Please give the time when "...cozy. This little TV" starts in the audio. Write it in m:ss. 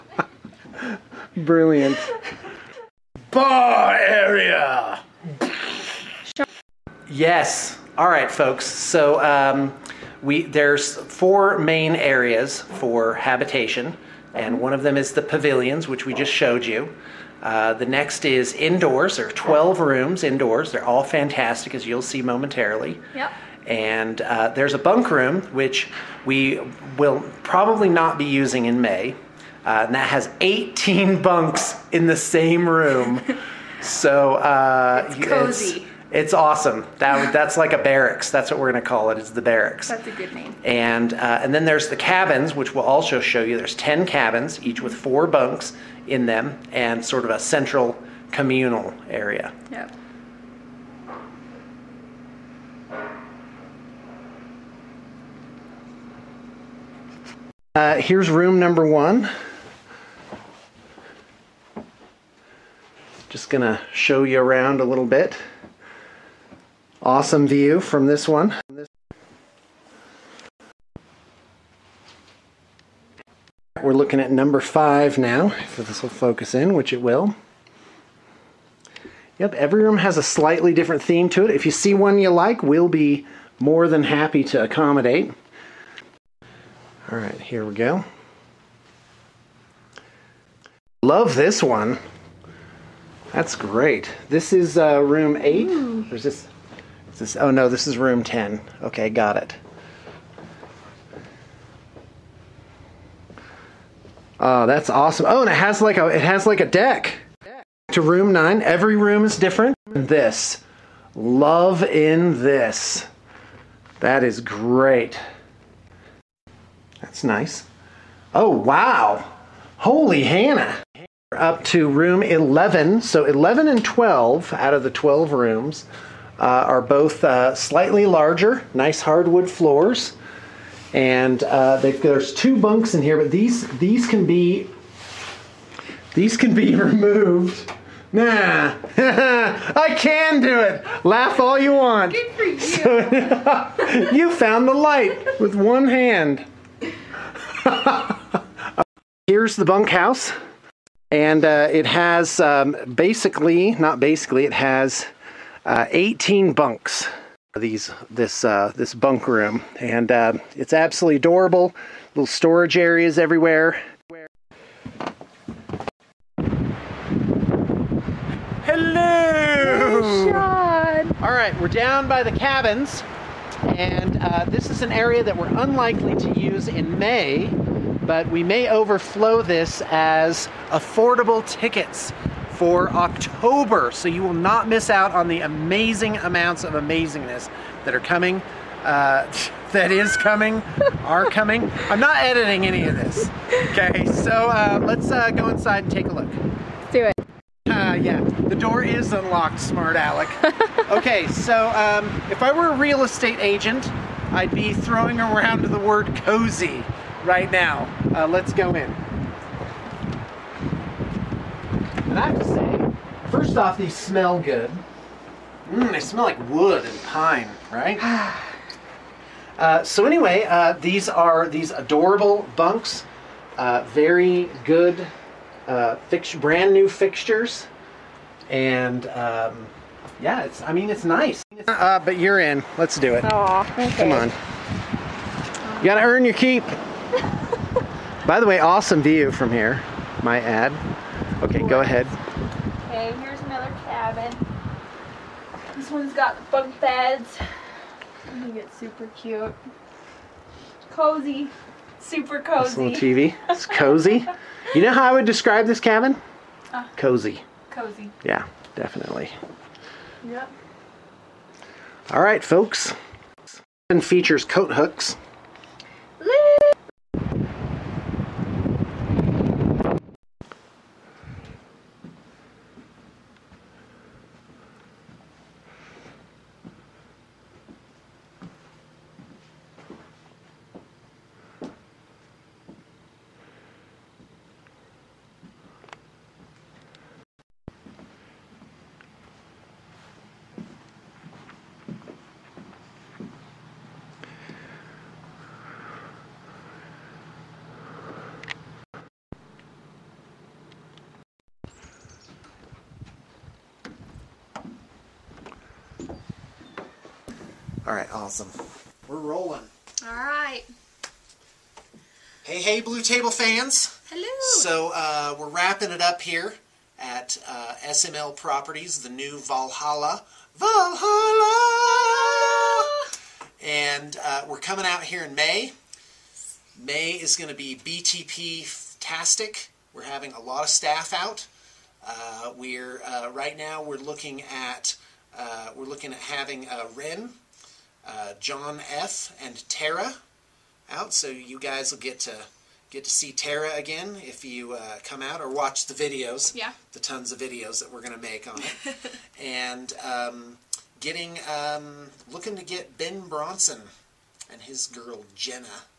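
4:12.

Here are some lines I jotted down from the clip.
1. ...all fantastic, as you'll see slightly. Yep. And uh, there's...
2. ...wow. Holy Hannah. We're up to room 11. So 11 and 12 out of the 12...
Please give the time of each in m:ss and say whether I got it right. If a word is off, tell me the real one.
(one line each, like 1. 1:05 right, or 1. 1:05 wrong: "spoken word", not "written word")
1. 0:20 wrong: "momentarily", not "slightly"
2. 1:58 right.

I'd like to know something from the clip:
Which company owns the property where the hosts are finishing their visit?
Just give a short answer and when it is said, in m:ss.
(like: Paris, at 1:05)
SML Properties, at 5:17.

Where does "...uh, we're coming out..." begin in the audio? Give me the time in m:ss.
5:24.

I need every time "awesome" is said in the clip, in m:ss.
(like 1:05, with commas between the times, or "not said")
0:36, 1:07, 1:44, 3:58, 5:08.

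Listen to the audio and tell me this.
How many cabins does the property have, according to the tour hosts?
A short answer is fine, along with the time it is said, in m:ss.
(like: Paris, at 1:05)
10, at 0:43.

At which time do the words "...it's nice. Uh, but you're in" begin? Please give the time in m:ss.
3:50.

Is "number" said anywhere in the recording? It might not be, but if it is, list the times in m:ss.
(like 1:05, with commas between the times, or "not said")
0:58, 1:14.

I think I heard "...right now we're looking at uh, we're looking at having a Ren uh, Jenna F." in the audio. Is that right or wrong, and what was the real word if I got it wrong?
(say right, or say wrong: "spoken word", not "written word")
wrong: "John", not "Jenna".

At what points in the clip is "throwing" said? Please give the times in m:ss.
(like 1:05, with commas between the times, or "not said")
3:24.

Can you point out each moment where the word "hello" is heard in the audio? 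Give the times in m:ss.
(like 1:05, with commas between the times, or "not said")
2:48, 5:14.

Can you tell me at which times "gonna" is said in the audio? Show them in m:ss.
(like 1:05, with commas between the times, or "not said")
1:03.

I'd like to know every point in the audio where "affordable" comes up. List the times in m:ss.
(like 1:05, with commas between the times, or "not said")
3:00.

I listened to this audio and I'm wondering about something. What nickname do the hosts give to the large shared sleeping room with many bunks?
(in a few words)
the barracks.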